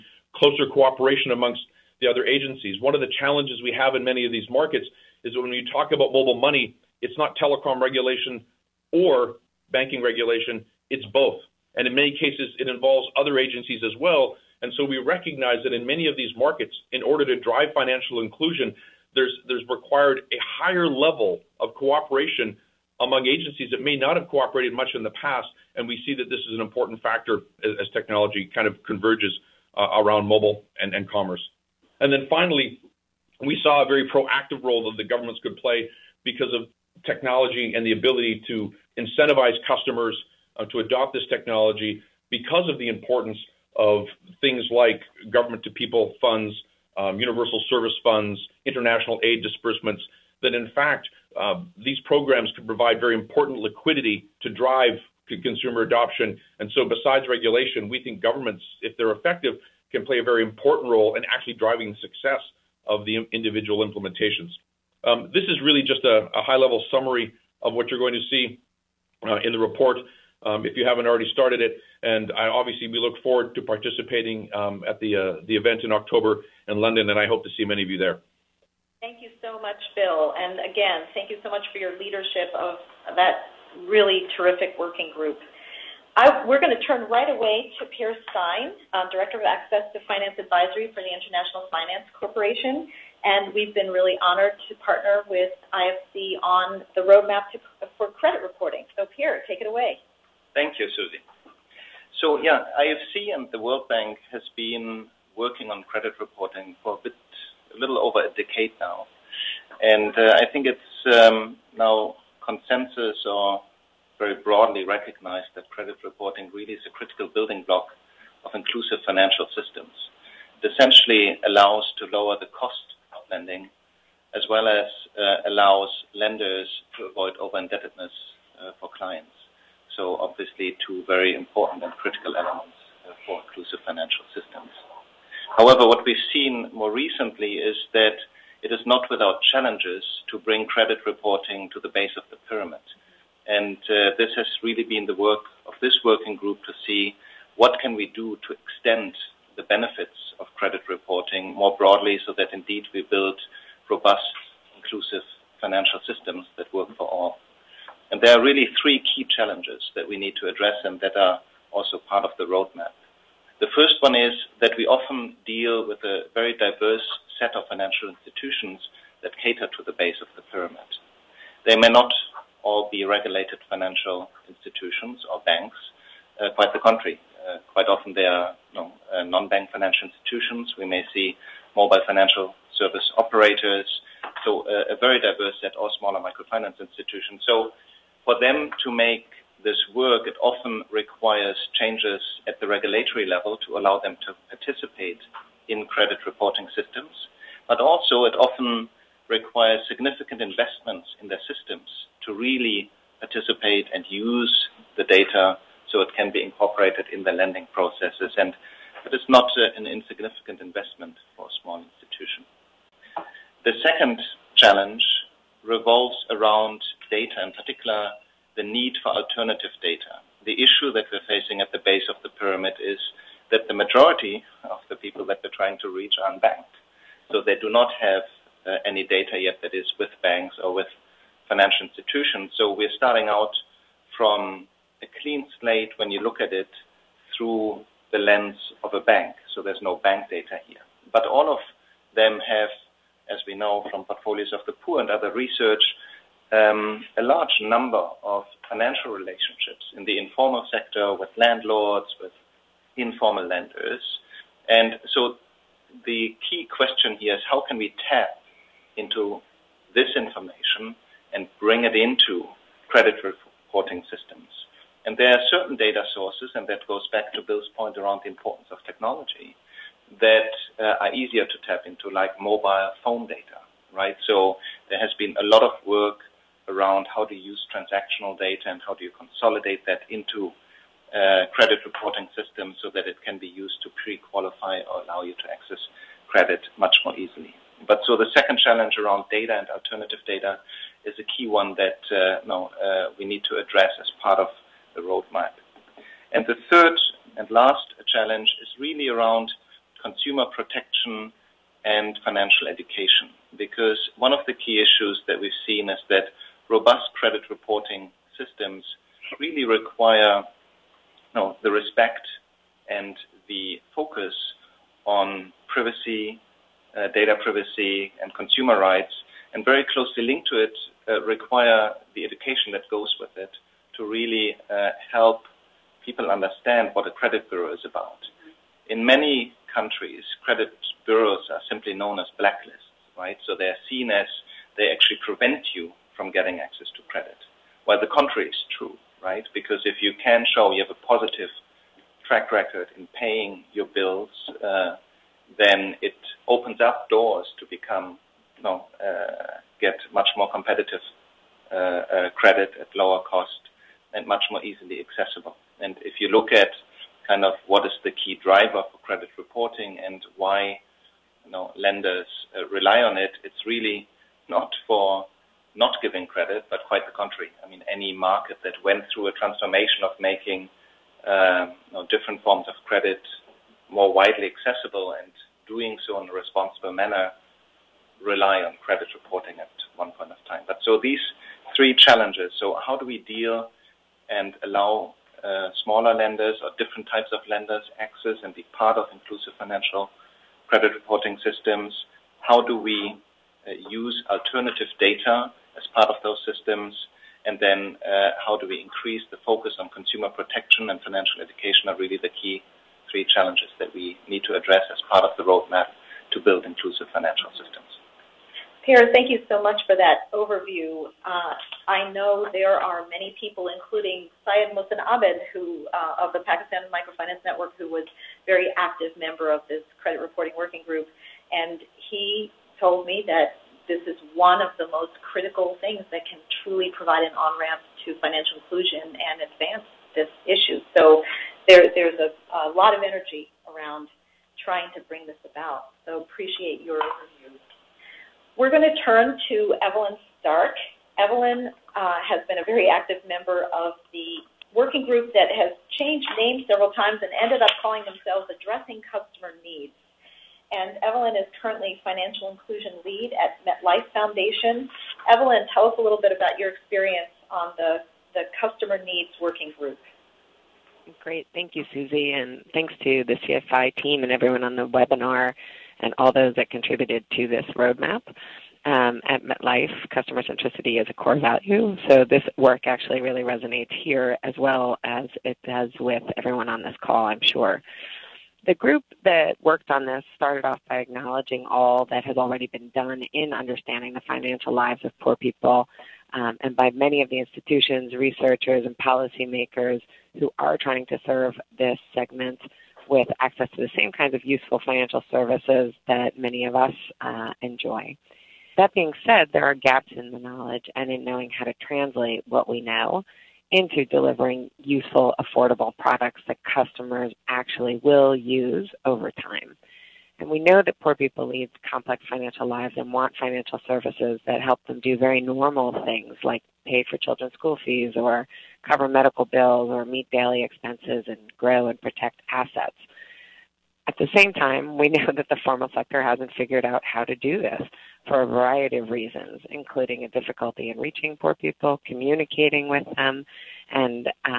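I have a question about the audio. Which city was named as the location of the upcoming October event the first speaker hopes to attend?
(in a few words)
London.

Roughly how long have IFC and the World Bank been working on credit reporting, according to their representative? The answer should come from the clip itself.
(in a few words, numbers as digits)
A little over a decade.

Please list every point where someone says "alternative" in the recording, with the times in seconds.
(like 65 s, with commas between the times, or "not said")
219 s, 289 s, 394 s.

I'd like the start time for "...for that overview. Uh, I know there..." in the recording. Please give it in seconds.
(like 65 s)
409 s.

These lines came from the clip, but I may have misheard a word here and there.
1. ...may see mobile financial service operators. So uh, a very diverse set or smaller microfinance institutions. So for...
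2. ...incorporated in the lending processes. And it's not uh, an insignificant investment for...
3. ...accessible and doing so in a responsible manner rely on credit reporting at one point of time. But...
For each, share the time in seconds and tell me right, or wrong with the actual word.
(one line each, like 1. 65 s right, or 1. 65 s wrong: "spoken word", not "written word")
1. 180 s right
2. 206 s right
3. 374 s right.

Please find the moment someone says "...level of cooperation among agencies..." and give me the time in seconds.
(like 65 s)
20 s.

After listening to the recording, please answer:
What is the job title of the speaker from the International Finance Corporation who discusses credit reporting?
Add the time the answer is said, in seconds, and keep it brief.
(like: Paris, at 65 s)
Director of Access to Finance Advisory, at 89 s.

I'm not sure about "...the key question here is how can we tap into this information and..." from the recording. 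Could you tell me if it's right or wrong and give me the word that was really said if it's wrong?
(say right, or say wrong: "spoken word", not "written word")
right.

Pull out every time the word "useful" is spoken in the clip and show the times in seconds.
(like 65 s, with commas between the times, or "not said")
494 s, 504 s.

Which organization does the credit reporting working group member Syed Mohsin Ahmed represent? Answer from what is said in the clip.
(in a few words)
Pakistan Microfinance Network.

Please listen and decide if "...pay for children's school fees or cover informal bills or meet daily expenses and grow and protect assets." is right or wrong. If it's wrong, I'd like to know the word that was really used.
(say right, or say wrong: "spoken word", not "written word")
wrong: "medical", not "informal".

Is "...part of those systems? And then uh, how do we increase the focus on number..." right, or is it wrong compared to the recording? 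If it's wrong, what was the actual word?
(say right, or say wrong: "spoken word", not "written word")
wrong: "consumer", not "number".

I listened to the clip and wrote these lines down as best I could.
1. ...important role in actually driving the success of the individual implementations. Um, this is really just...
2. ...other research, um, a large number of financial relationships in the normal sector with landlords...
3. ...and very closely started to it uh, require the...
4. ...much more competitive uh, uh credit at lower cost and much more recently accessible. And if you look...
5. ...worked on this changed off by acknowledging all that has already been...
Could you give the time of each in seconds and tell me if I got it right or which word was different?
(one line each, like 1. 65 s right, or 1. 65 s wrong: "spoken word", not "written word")
1. 60 s right
2. 245 s wrong: "informal", not "normal"
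3. 319 s wrong: "linked", not "started"
4. 350 s wrong: "easily", not "recently"
5. 479 s wrong: "started", not "changed".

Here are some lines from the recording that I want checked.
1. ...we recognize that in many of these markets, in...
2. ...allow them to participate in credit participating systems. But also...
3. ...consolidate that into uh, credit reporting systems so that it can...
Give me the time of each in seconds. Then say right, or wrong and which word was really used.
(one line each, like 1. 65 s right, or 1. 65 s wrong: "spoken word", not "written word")
1. 14 s right
2. 193 s wrong: "reporting", not "participating"
3. 279 s right.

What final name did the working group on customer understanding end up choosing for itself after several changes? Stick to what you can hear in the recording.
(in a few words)
Addressing Customer Needs.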